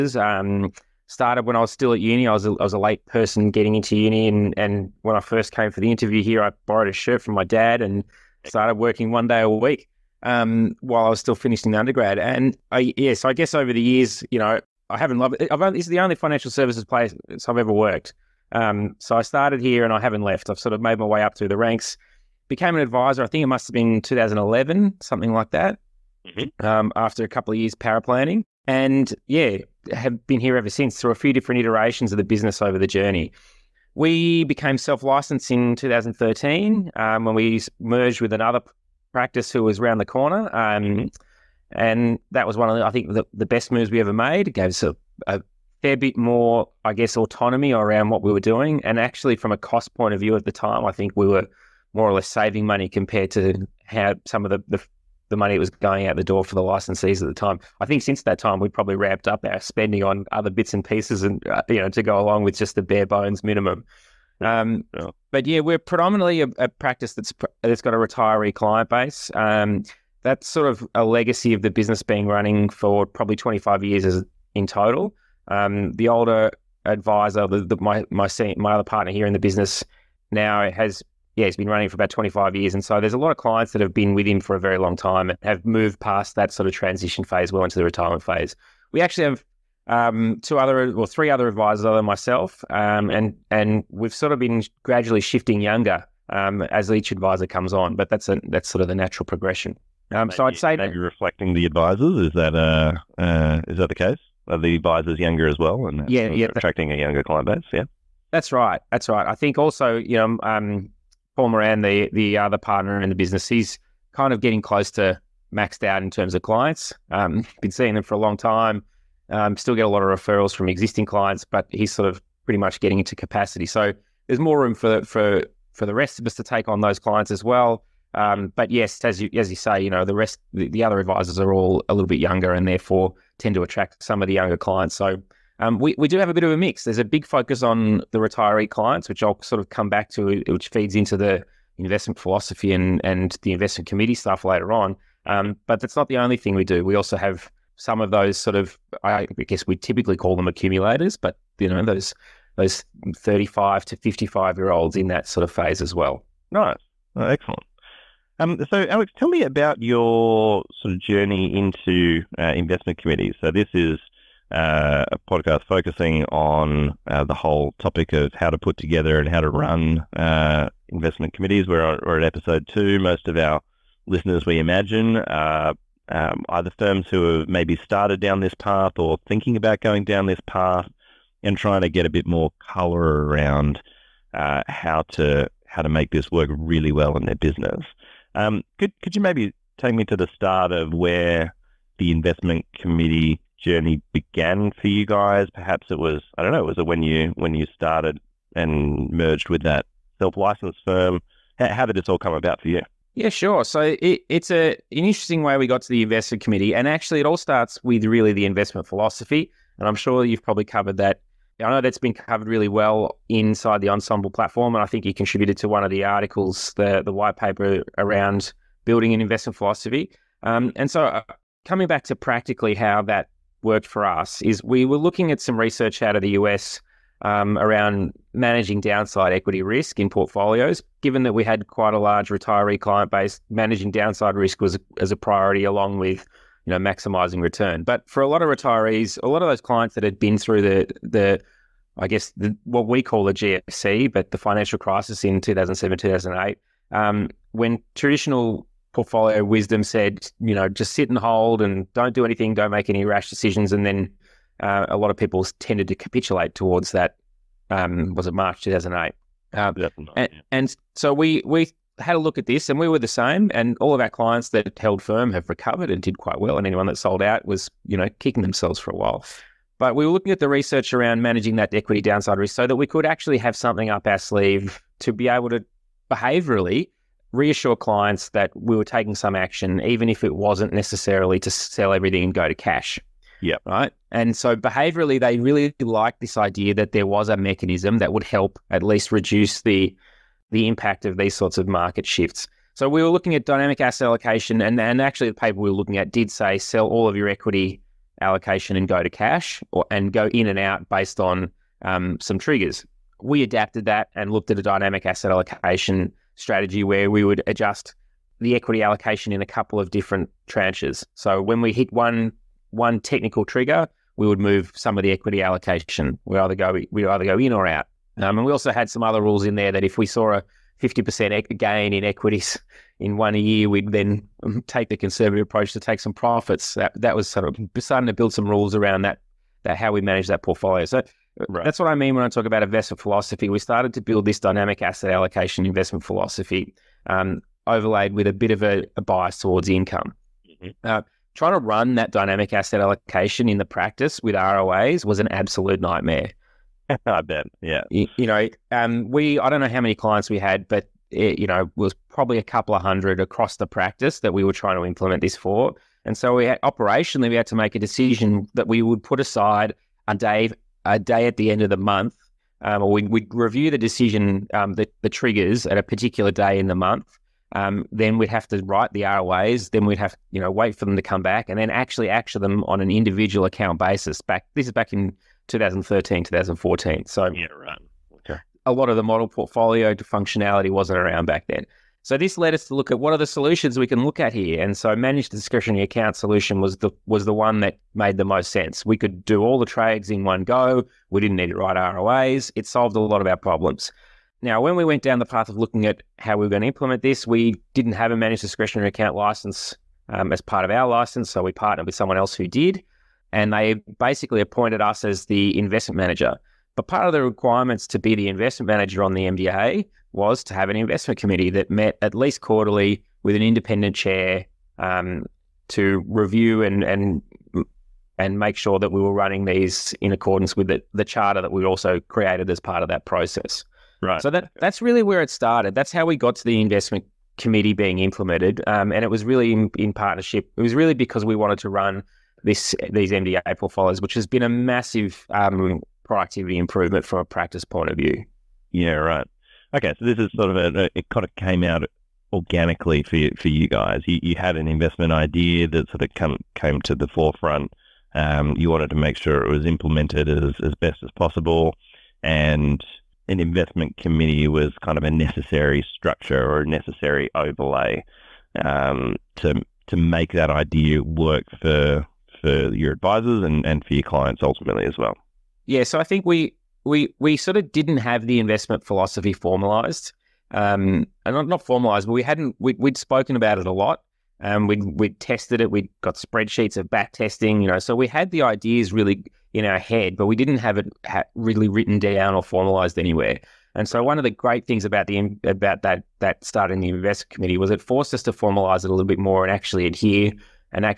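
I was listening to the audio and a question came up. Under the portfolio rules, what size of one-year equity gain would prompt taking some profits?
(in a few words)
50%.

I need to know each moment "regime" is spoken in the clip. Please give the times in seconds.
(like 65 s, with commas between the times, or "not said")
not said.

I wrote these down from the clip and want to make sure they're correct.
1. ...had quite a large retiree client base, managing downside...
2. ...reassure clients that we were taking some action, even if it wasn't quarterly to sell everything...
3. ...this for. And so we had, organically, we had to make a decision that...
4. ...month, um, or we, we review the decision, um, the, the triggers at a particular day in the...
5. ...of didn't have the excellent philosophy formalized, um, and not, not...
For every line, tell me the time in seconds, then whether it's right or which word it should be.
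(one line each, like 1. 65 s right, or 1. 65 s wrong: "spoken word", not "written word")
1. 231 s right
2. 277 s wrong: "necessarily", not "quarterly"
3. 355 s wrong: "operationally", not "organically"
4. 361 s right
5. 467 s wrong: "investment", not "excellent".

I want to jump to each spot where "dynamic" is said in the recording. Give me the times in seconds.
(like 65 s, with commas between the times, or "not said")
293 s, 304 s, 334 s, 342 s.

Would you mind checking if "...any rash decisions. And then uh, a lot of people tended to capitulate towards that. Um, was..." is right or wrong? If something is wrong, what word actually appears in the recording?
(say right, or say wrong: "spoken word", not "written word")
right.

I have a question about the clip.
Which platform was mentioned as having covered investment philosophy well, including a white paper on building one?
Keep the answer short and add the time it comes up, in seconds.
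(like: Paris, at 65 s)
Ensombl, at 213 s.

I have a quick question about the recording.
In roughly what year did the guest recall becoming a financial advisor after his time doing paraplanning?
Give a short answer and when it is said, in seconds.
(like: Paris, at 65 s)
2011, at 24 s.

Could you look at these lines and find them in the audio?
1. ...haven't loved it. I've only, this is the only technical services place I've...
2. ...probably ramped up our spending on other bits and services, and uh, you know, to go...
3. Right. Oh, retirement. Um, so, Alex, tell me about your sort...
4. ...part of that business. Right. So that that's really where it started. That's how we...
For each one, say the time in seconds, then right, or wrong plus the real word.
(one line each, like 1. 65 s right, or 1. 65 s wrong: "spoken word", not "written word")
1. 14 s wrong: "financial", not "technical"
2. 58 s wrong: "pieces", not "services"
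3. 156 s wrong: "excellent", not "retirement"
4. 422 s wrong: "process", not "business".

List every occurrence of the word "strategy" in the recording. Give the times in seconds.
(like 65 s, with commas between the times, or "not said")
306 s.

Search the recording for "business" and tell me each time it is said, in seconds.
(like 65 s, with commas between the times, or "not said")
32 s, 71 s, 79 s, 113 s, 187 s.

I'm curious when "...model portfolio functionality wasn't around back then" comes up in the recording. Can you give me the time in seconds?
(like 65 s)
379 s.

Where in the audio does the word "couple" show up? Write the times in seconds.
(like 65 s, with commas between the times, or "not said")
27 s, 309 s, 352 s.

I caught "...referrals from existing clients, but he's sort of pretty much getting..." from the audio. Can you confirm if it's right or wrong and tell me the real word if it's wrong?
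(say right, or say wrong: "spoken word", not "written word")
right.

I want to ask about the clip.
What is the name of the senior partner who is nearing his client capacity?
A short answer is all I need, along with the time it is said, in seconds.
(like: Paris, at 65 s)
Paul Moran, at 111 s.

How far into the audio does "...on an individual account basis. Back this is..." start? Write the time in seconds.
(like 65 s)
372 s.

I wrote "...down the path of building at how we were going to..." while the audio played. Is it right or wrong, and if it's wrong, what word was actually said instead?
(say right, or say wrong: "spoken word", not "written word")
wrong: "looking", not "building".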